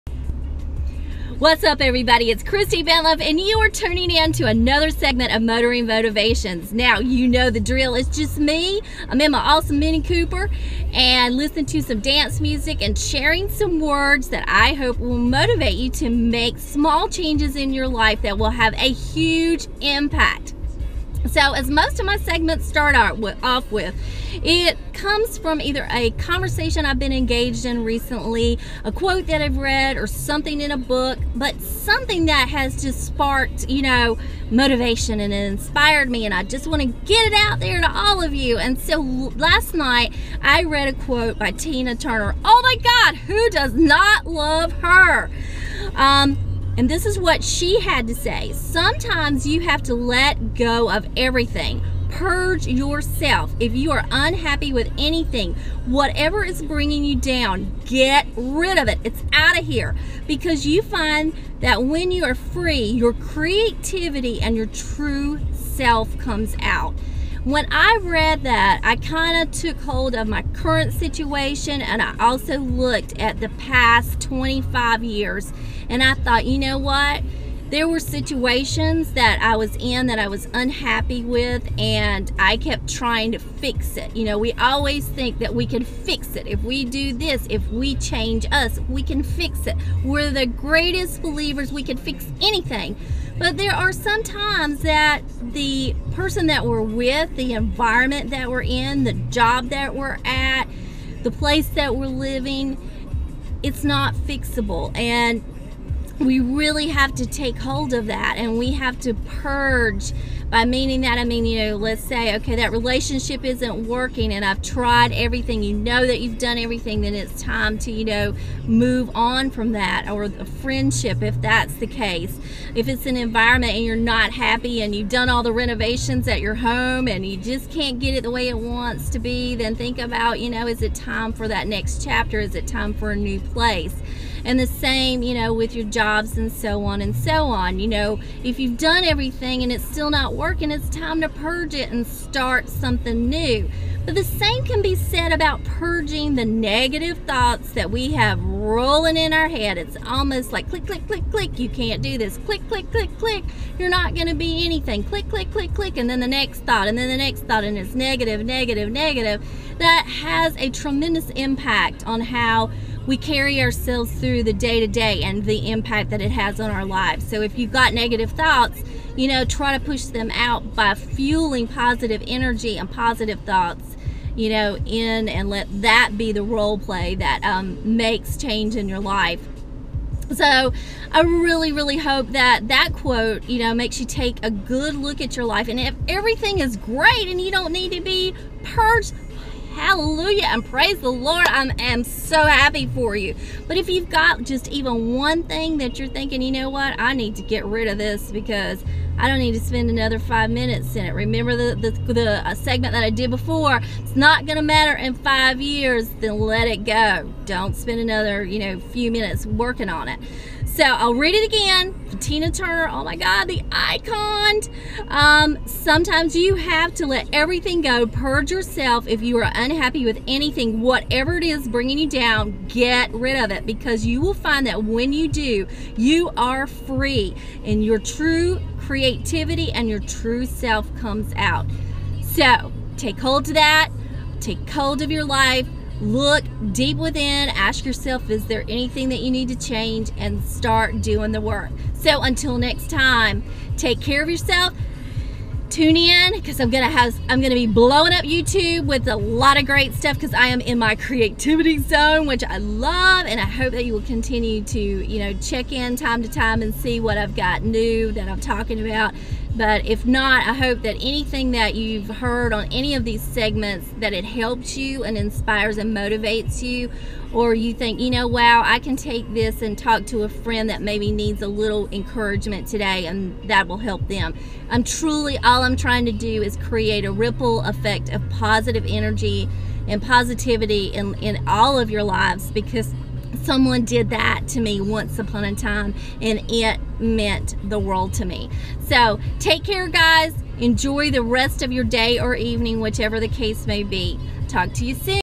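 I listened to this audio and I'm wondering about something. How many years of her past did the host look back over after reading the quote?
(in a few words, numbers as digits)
25.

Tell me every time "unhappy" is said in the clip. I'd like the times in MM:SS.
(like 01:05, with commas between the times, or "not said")
00:54, 01:20, 03:39.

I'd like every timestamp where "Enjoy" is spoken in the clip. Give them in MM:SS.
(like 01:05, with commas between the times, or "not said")
04:50.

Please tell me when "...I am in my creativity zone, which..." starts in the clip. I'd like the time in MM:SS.
04:10.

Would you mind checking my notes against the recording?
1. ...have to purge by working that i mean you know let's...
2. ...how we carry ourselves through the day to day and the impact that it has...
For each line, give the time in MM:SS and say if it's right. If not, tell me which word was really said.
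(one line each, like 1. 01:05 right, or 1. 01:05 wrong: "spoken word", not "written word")
1. 01:48 wrong: "meaning", not "working"
2. 02:42 right.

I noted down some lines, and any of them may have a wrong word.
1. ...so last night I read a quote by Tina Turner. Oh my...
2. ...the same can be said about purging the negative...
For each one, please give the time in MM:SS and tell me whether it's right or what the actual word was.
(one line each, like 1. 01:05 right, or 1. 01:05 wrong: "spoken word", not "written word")
1. 00:38 right
2. 02:24 right.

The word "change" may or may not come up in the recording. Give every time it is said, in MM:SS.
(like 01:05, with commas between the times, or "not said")
00:17, 01:27, 02:58, 03:59.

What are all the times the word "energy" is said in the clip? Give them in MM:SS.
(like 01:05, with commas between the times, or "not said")
02:52, 04:38.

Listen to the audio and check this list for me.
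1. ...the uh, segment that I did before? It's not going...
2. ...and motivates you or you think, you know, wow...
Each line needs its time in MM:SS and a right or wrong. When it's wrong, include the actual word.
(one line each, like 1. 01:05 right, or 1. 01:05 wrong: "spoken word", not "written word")
1. 03:22 right
2. 04:25 right.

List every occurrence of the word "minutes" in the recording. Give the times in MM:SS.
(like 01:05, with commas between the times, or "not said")
03:20, 03:29.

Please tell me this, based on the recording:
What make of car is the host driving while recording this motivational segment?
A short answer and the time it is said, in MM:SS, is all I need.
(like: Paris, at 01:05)
Mini Cooper, at 00:09.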